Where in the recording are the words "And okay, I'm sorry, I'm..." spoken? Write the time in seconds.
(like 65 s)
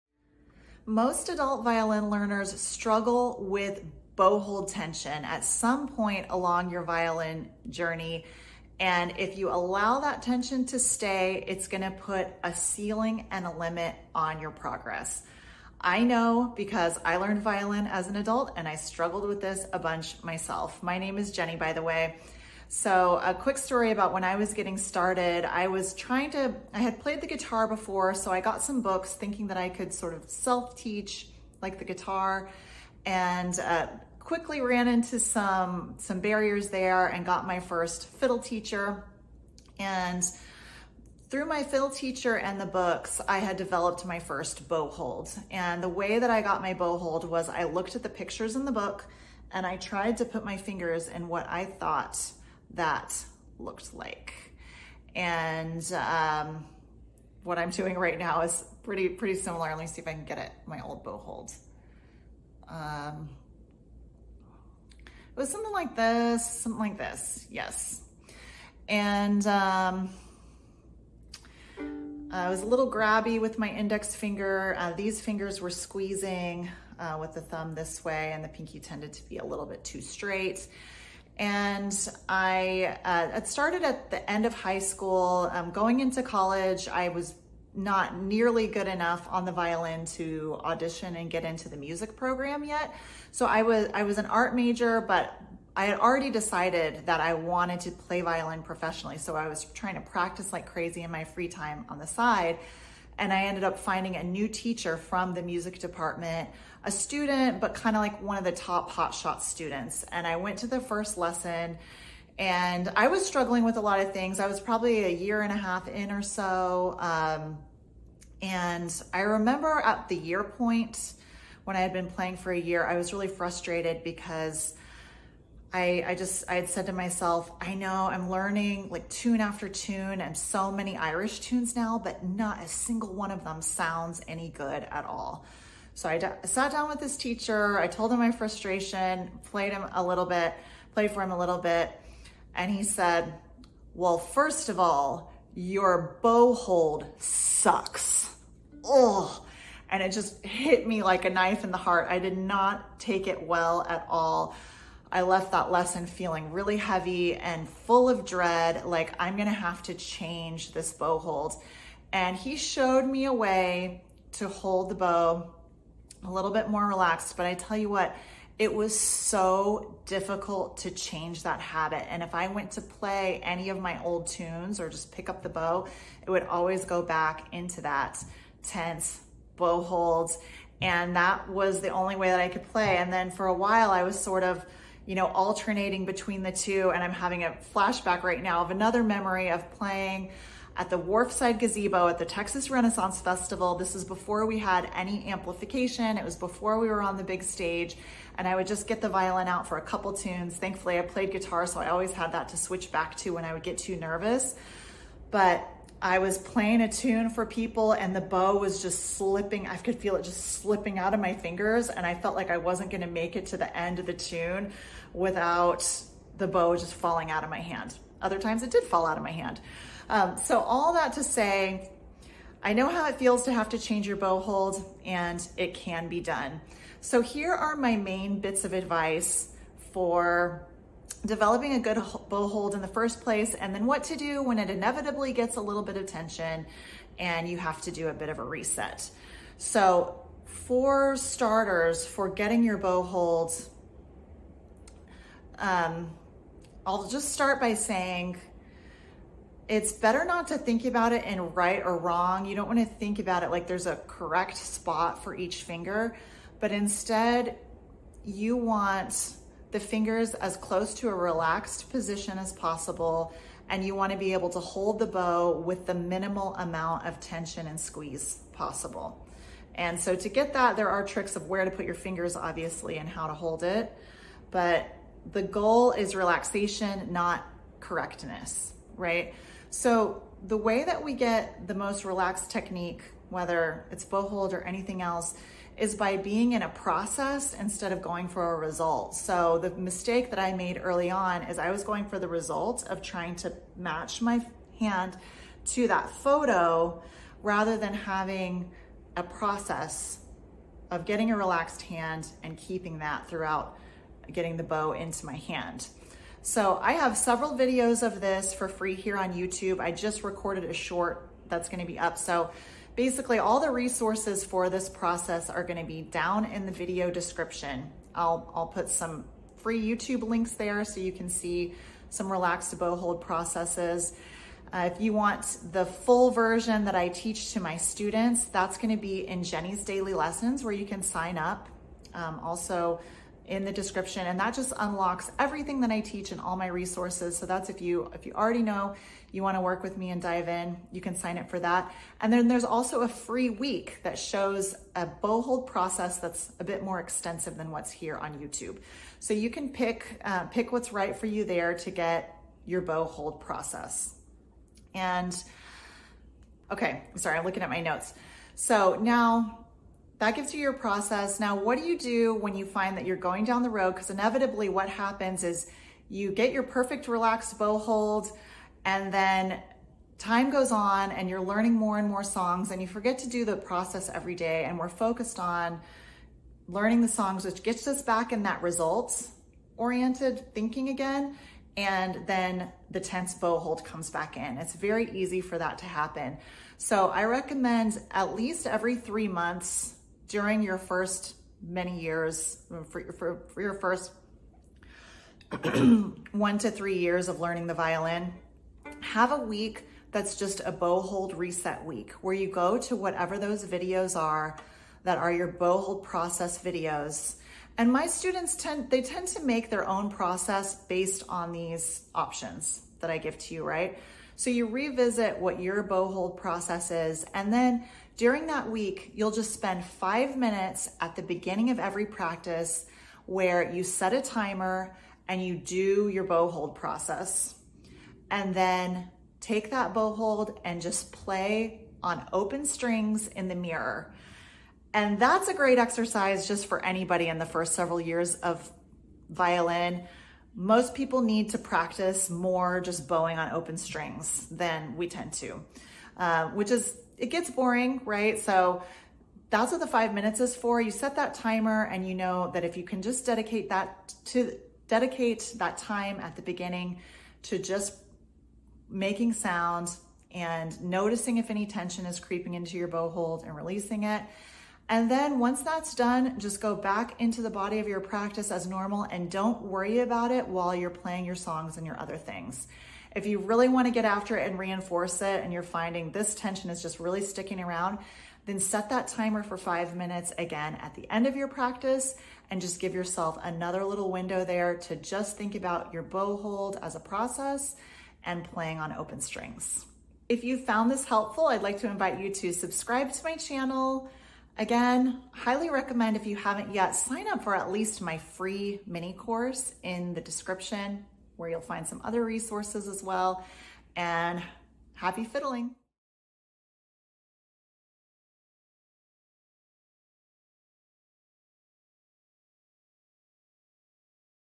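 354 s.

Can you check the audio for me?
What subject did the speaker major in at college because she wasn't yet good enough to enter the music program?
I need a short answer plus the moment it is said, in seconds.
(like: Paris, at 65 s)
Art, at 94 s.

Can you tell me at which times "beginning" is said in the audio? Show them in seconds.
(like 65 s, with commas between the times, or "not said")
421 s, 456 s.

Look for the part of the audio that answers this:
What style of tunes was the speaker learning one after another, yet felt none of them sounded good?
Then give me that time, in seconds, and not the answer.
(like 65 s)
130 s.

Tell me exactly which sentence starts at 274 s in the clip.
But the goal is relaxation, not correctness, right?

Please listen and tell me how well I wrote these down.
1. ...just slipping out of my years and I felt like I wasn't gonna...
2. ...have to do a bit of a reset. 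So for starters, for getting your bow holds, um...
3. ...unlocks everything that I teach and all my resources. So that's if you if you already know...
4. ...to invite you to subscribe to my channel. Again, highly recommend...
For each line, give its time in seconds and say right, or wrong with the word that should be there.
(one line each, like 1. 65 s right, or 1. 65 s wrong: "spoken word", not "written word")
1. 210 s wrong: "fingers", not "years"
2. 237 s right
3. 334 s right
4. 491 s right.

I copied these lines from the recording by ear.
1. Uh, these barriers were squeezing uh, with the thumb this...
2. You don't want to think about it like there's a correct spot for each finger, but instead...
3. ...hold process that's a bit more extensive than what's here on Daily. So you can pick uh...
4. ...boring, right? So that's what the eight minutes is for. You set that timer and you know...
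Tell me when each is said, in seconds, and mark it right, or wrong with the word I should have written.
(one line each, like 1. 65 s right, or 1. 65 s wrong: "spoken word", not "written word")
1. 74 s wrong: "fingers", not "barriers"
2. 252 s right
3. 345 s wrong: "YouTube", not "Daily"
4. 447 s wrong: "five", not "eight".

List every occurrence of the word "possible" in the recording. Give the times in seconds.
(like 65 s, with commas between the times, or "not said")
262 s, 268 s.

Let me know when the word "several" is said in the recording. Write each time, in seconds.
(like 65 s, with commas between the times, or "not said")
307 s, 437 s.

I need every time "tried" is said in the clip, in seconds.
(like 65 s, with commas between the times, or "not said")
49 s.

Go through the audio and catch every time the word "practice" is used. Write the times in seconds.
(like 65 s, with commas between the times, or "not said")
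100 s, 422 s, 441 s, 468 s, 481 s.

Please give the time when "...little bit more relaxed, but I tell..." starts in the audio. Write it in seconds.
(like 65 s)
166 s.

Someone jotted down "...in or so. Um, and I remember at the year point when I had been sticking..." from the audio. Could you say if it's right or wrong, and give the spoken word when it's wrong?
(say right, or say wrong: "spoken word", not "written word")
wrong: "playing", not "sticking".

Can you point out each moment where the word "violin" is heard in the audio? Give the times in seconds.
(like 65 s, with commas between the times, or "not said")
1 s, 6 s, 17 s, 89 s, 98 s, 199 s, 397 s, 439 s.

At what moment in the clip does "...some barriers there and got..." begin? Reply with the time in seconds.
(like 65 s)
35 s.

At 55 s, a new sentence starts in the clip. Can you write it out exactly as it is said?
And um, what I'm doing right now is pretty, pretty similar.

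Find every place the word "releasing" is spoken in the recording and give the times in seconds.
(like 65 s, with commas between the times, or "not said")
463 s.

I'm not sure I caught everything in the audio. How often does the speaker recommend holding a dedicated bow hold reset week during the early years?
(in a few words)
Every 3 months.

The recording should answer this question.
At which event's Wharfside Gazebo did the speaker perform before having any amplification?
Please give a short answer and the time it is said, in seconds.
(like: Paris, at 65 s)
Texas Renaissance Festival, at 192 s.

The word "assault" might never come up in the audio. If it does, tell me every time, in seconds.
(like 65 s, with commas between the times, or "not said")
not said.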